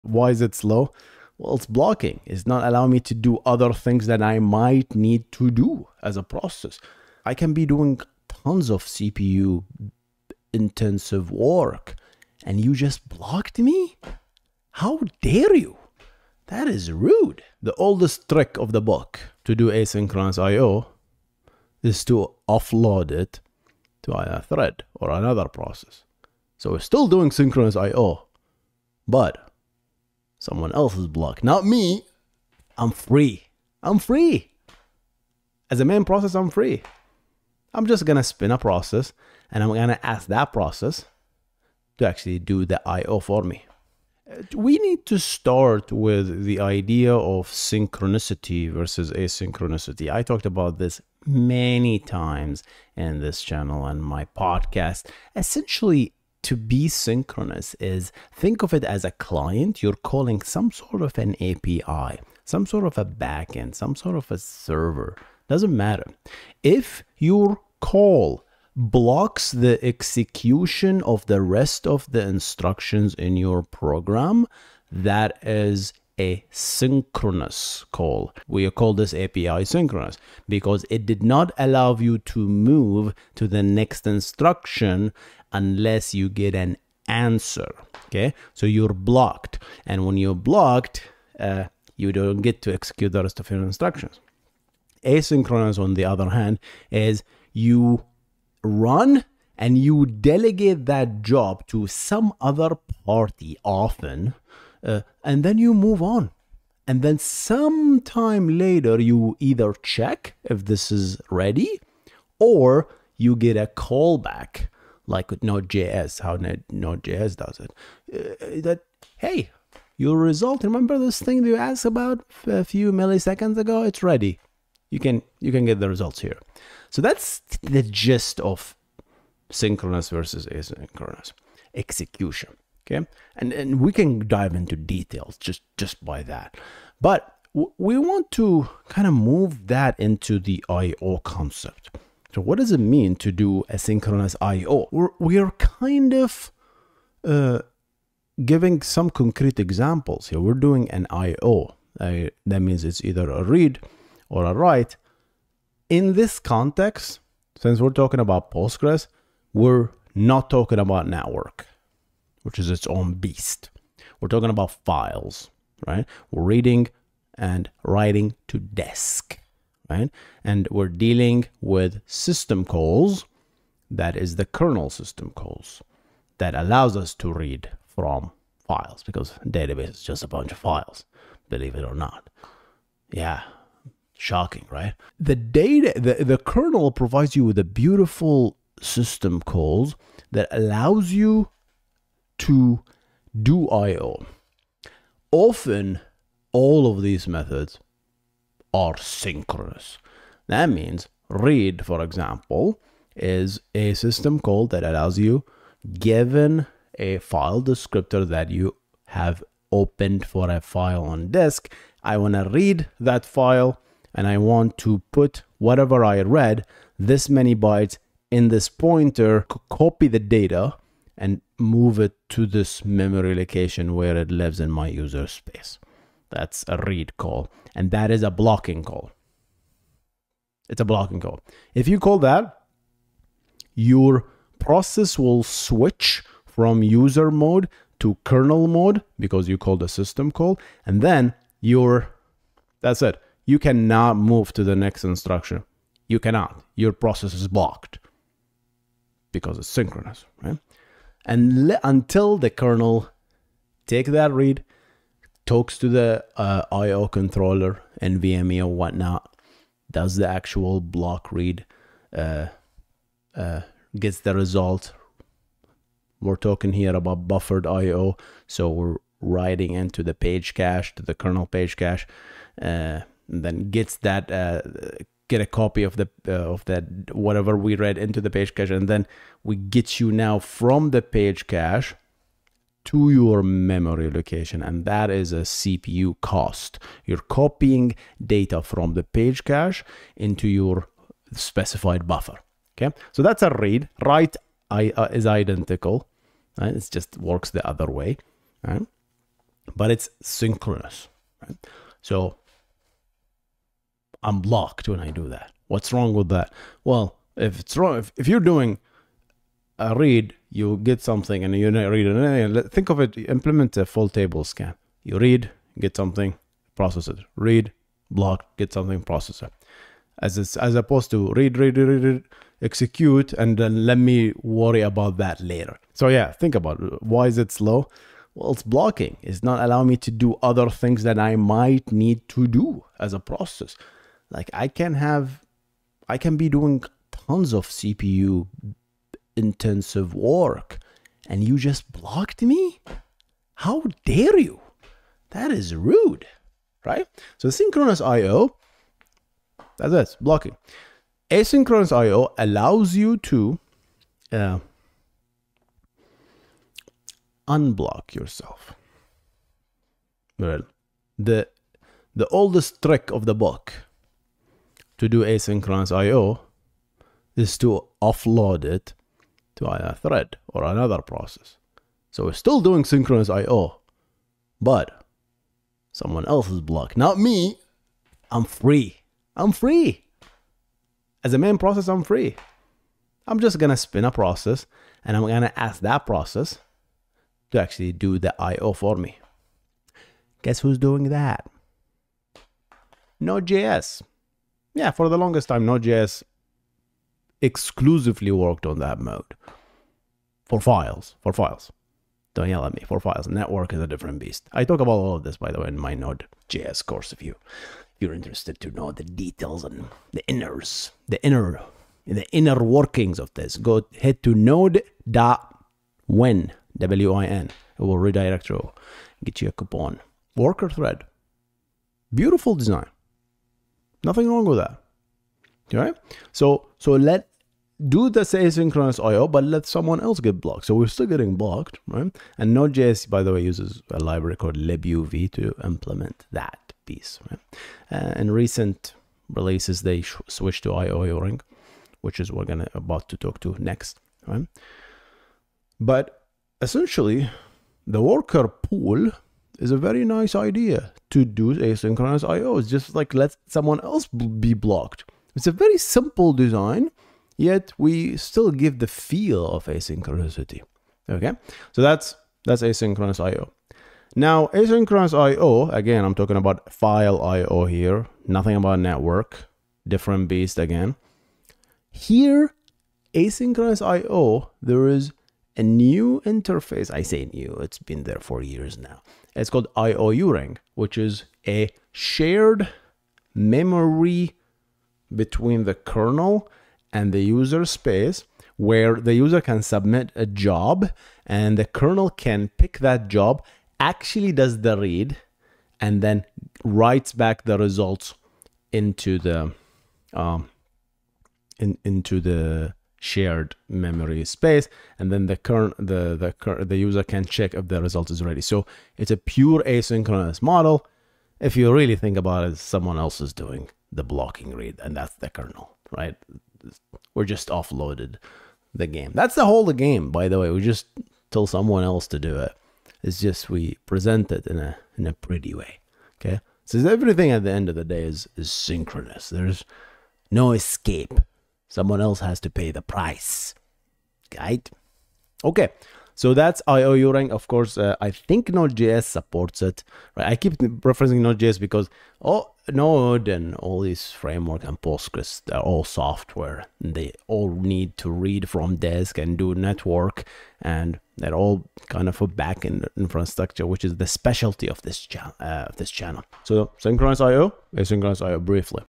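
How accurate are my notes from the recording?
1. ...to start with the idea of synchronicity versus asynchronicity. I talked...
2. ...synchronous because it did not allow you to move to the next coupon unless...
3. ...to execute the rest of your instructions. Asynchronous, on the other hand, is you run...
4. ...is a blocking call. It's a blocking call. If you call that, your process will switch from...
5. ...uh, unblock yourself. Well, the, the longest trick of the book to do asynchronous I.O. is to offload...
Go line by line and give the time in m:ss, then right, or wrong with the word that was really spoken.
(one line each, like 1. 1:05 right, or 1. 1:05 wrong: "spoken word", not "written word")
1. 0:45 right
2. 1:19 wrong: "instruction", not "coupon"
3. 1:32 right
4. 3:48 right
5. 5:54 wrong: "oldest", not "longest".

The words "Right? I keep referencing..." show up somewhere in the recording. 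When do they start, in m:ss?
9:00.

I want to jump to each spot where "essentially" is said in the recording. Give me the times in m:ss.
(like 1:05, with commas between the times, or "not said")
0:55, 7:26.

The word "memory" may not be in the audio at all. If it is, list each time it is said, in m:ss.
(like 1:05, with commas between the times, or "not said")
3:42, 4:43, 8:03, 8:23.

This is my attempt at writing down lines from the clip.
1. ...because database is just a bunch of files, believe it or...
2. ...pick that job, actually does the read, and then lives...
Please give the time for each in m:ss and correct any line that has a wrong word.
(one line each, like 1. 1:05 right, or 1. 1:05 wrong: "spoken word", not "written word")
1. 2:59 right
2. 8:12 wrong: "writes", not "lives".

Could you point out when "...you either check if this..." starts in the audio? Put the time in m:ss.
1:48.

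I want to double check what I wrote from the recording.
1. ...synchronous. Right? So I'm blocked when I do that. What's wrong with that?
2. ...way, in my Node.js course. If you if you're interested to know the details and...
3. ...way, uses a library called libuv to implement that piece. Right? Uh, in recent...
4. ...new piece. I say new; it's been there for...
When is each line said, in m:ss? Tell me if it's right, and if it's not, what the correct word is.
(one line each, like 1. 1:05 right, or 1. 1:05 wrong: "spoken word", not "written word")
1. 5:00 right
2. 6:45 right
3. 7:13 right
4. 7:55 wrong: "interface", not "piece".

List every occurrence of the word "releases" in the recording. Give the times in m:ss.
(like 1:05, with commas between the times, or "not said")
7:19.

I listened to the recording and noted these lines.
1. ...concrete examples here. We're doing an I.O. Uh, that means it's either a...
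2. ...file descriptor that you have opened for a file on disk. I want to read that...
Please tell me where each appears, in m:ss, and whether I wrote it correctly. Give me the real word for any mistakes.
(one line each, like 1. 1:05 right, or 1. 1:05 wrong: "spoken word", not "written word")
1. 2:29 right
2. 3:27 right.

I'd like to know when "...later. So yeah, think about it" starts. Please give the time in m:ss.
5:25.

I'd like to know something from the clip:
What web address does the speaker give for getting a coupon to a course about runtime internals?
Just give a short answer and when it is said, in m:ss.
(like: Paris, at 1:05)
node.win, at 6:54.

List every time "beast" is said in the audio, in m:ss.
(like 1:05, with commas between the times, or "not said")
2:43, 6:44, 7:50.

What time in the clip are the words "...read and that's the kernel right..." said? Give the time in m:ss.
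8:34.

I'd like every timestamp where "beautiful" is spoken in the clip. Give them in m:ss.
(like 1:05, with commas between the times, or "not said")
3:07, 7:02.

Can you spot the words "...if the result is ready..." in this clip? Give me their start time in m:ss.
8:27.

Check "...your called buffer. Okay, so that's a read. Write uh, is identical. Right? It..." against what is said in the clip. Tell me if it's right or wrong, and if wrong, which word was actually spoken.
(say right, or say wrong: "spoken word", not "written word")
wrong: "specified", not "called".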